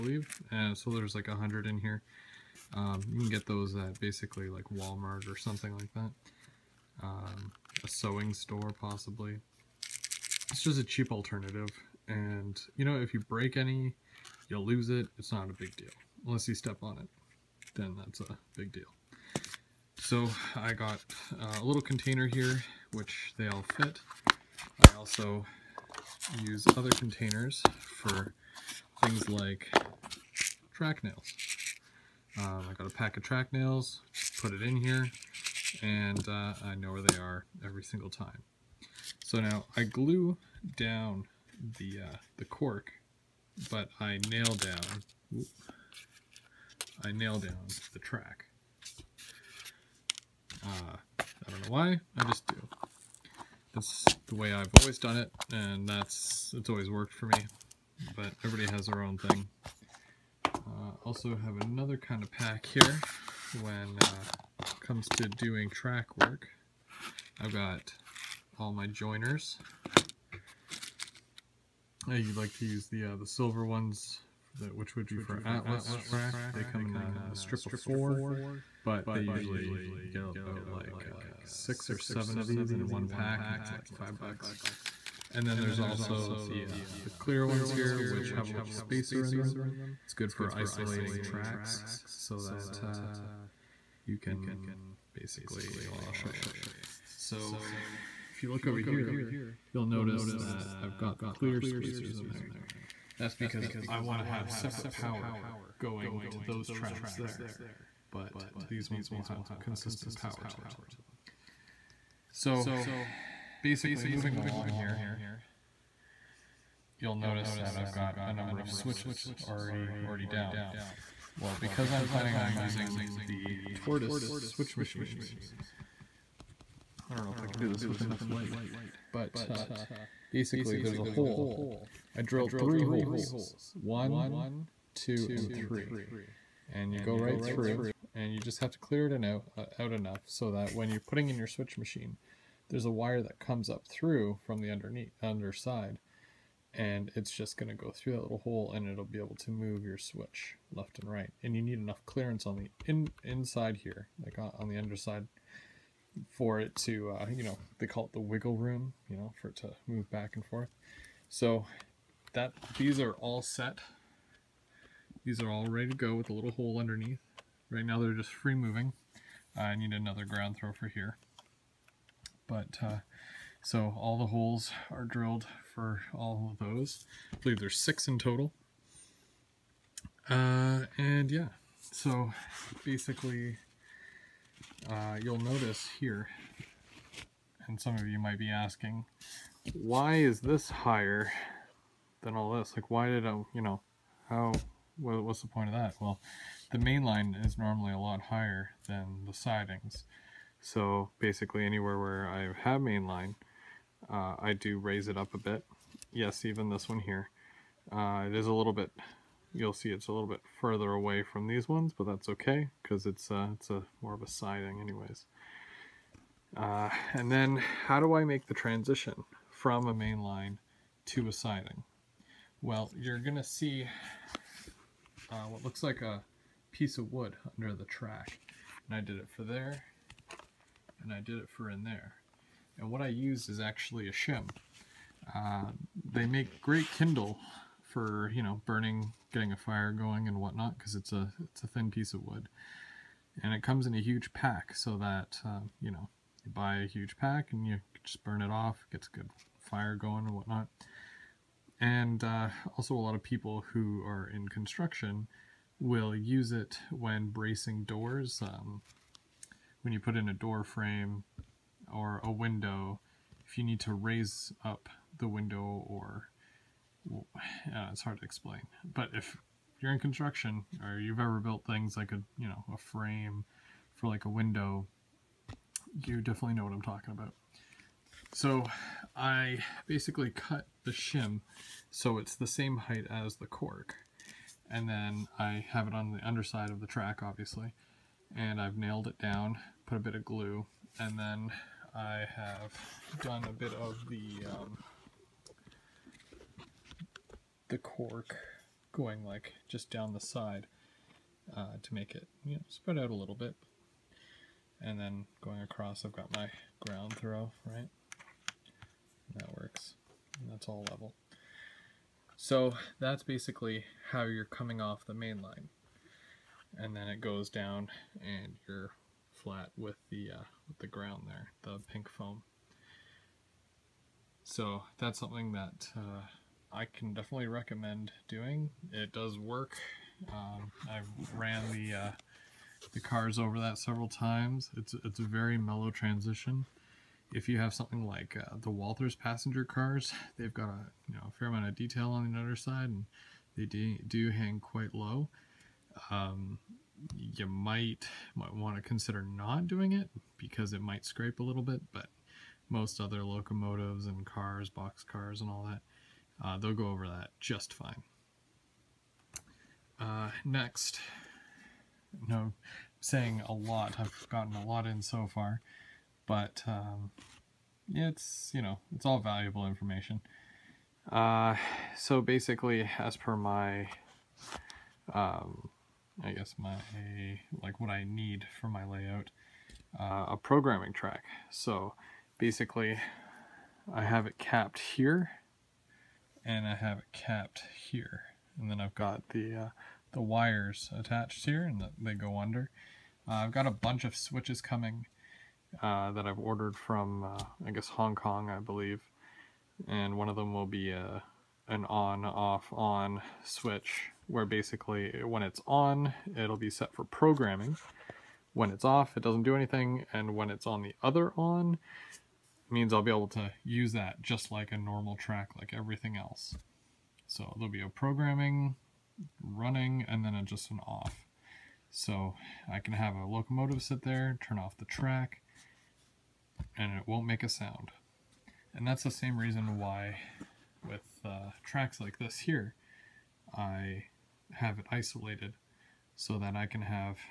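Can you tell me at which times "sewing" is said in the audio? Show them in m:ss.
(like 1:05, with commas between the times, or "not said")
0:07.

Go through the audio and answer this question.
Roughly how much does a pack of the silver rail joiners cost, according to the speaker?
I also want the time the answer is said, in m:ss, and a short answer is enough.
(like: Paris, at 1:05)
5 bucks, at 1:23.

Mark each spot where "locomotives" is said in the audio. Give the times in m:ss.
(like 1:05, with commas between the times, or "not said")
5:53, 7:03.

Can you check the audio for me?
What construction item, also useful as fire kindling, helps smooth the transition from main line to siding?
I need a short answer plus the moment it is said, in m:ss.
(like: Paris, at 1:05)
A shim, at 3:54.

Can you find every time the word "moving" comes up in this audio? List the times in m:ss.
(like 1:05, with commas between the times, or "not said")
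1:54, 2:48.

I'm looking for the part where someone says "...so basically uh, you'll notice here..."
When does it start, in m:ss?
3:01.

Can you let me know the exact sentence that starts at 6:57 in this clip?
So there'll be a programming, running, and then a, just an off.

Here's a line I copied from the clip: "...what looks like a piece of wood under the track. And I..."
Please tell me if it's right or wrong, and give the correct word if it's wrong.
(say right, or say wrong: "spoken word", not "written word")
right.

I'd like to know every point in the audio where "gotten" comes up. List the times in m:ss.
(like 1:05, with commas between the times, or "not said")
6:04.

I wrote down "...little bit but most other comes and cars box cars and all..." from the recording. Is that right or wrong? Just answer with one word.
wrong.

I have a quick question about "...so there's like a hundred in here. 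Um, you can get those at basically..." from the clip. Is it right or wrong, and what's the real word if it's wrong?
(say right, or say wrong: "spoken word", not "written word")
right.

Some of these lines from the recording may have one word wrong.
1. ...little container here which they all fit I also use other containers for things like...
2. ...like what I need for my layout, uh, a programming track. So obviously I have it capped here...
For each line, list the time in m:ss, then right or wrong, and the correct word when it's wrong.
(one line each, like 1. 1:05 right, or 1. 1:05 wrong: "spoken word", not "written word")
1. 0:21 right
2. 6:17 wrong: "basically", not "obviously".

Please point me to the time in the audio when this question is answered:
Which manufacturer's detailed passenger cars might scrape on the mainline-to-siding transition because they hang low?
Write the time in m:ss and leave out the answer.
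5:38.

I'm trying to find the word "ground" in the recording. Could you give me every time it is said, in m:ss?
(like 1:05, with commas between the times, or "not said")
2:50, 5:06, 5:20.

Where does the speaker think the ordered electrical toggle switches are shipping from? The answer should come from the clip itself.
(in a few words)
Hong Kong.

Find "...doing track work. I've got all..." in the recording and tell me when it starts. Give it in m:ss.
1:05.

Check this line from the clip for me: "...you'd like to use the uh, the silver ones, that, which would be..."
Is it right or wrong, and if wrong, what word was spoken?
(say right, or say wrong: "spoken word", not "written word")
right.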